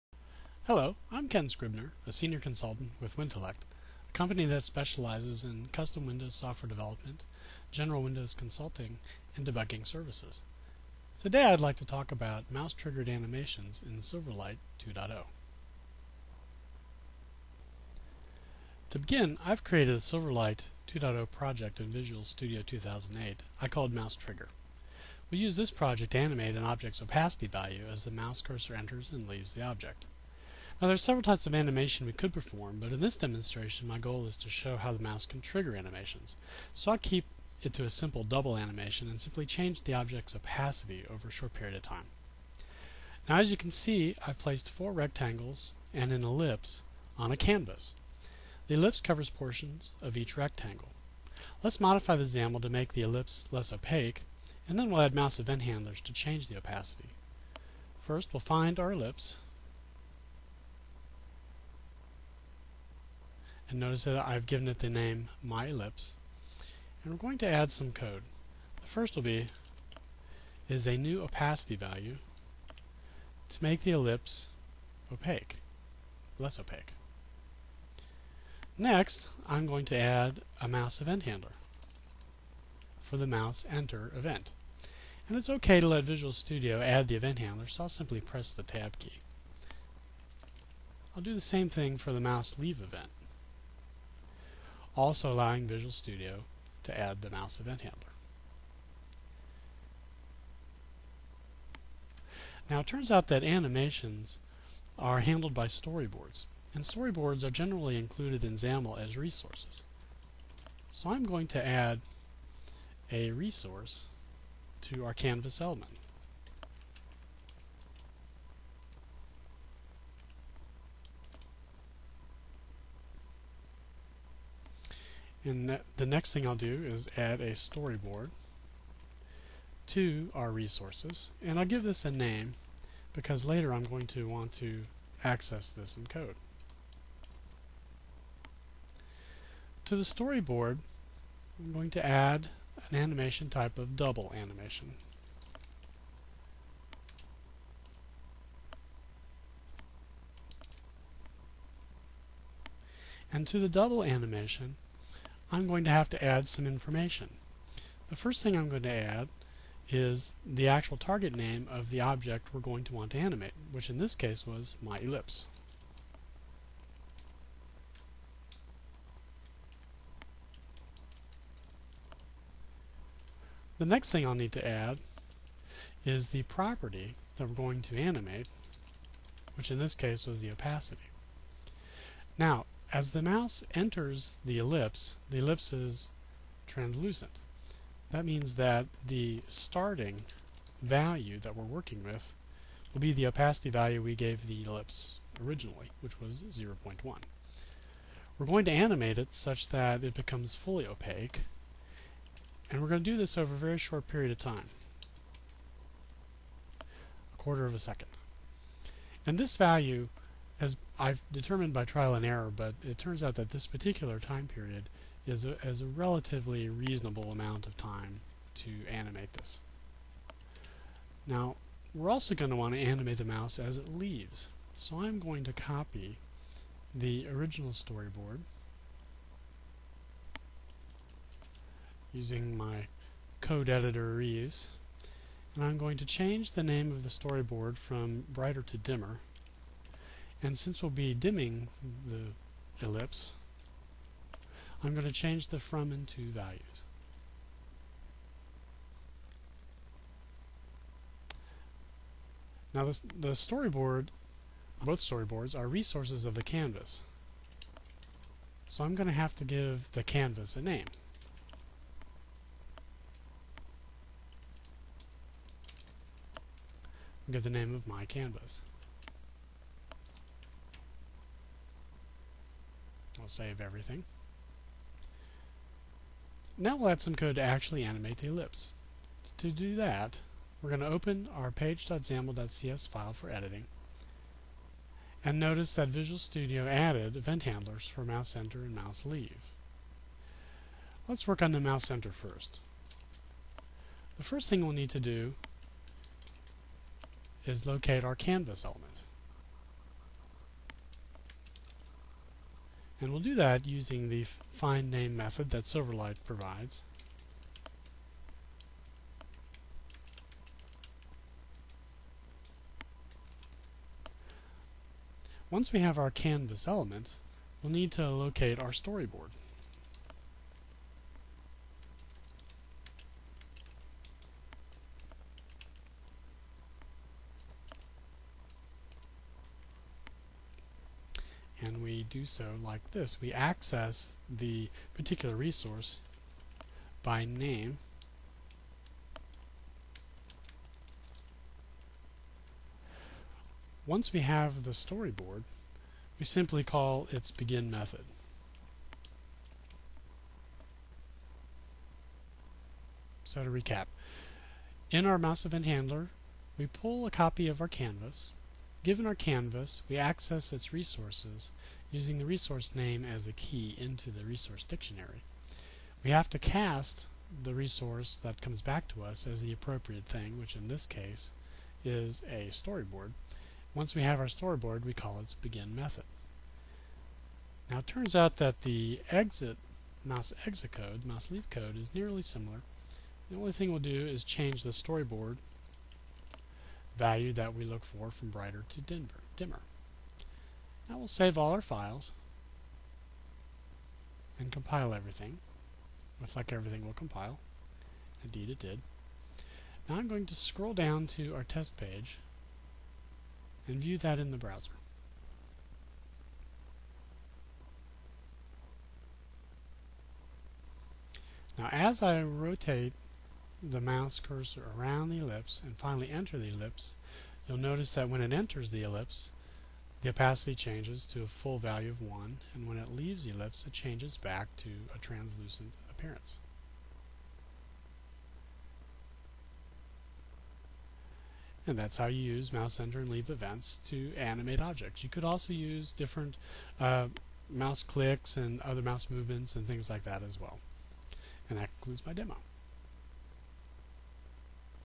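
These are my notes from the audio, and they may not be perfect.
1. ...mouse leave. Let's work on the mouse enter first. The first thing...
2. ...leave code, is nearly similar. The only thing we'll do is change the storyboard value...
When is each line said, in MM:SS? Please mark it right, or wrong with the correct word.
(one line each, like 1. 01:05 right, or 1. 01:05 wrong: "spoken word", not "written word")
1. 04:48 right
2. 06:21 right.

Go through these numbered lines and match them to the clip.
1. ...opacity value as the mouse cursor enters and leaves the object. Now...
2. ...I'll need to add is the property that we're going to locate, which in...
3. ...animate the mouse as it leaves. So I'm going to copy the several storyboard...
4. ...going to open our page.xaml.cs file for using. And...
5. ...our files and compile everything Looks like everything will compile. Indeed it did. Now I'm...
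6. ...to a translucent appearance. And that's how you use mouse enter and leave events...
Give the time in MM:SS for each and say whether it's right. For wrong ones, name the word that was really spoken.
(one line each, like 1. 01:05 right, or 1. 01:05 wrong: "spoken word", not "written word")
1. 00:27 right
2. 02:54 wrong: "animate", not "locate"
3. 03:42 wrong: "original", not "several"
4. 04:40 wrong: "editing", not "using"
5. 06:31 right
6. 07:04 right.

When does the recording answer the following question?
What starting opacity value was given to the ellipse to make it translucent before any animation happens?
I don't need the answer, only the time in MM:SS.
03:16.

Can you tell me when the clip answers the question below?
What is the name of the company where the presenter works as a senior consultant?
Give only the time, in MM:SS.
00:03.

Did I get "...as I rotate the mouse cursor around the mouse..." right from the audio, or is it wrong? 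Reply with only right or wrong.
wrong.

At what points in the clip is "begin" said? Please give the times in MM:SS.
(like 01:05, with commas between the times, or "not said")
00:18, 05:47, 06:15.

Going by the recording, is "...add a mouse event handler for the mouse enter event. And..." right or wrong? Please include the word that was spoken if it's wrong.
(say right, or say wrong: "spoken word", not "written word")
right.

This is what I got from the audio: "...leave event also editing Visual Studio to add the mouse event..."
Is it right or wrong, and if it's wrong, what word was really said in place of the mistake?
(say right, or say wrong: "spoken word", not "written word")
wrong: "allowing", not "editing".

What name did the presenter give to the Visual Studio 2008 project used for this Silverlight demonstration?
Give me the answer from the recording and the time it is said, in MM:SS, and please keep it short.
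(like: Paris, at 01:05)
Mouse Trigger, at 00:23.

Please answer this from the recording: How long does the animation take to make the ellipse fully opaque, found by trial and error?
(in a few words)
a quarter of a second.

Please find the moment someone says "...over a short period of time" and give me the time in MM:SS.
00:41.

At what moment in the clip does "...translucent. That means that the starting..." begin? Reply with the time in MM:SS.
03:06.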